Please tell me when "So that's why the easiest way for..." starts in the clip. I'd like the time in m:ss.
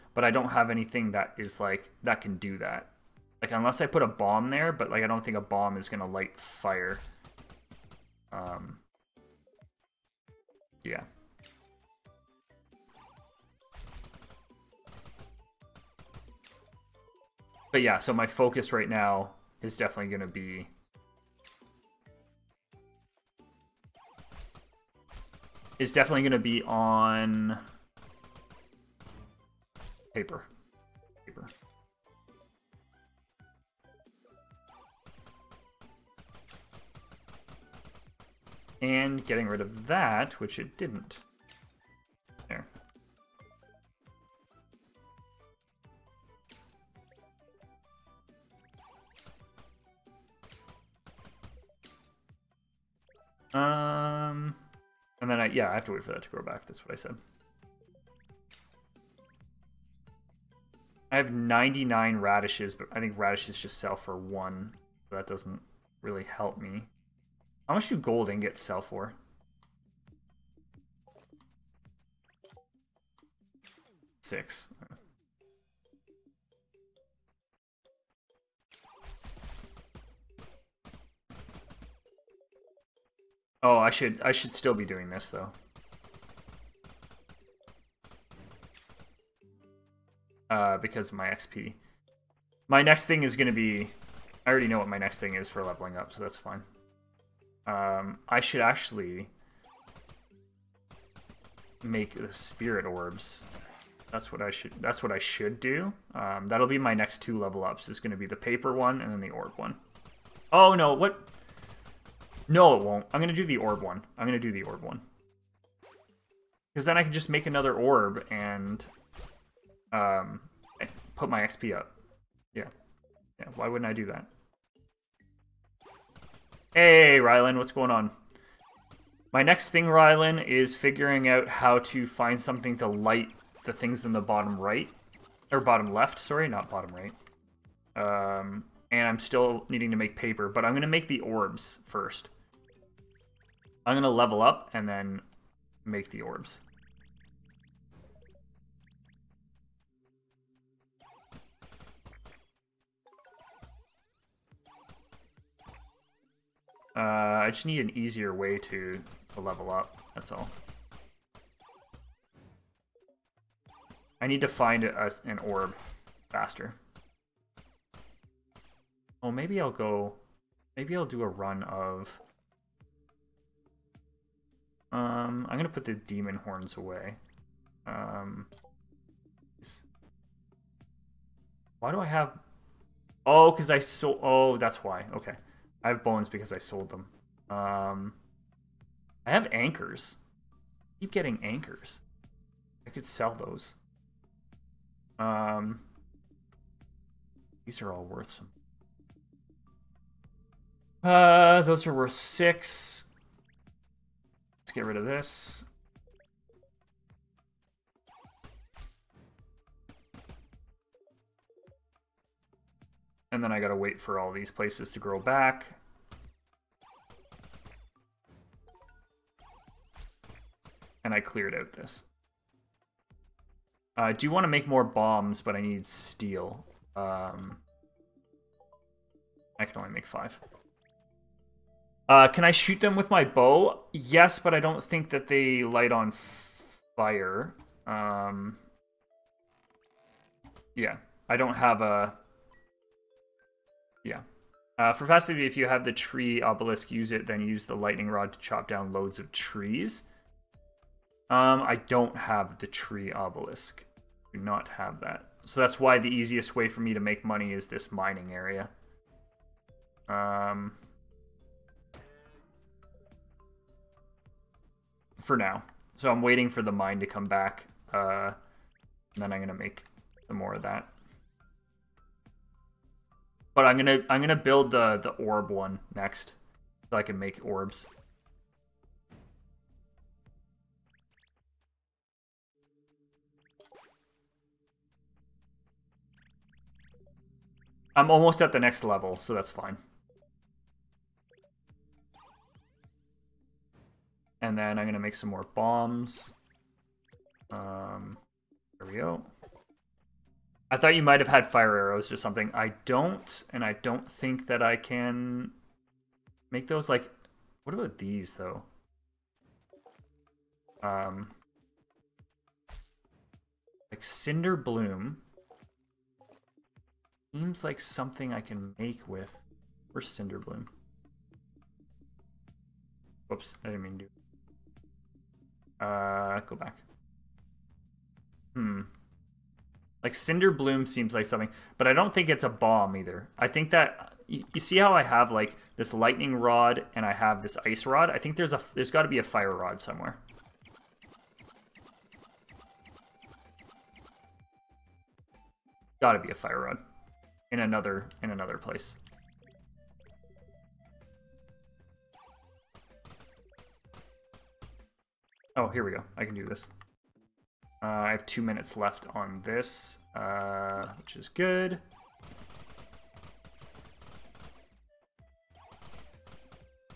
4:15.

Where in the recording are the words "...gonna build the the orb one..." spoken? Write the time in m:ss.
4:34.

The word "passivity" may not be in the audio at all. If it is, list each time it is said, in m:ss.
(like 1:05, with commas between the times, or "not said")
4:05.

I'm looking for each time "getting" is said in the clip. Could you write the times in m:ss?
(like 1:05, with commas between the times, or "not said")
0:39, 3:11.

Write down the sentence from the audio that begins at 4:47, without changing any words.
I'm almost at the next level, so that's fine.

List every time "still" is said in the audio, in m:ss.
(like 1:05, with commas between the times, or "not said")
1:24, 2:19.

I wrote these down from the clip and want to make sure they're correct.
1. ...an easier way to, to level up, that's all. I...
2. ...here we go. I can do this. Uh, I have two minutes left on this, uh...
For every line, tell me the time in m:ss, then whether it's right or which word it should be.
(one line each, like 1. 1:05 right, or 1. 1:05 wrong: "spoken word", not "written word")
1. 2:37 right
2. 5:55 right.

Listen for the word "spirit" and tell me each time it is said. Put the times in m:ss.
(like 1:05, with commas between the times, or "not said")
1:42.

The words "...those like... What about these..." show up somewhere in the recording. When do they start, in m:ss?
5:06.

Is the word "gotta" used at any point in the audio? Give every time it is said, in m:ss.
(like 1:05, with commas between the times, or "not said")
3:33.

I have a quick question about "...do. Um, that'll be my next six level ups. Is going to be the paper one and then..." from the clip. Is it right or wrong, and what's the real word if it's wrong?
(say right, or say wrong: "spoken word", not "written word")
wrong: "two", not "six".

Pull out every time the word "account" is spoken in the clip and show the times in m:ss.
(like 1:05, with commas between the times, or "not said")
not said.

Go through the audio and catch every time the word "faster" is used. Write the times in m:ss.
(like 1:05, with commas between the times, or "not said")
2:46.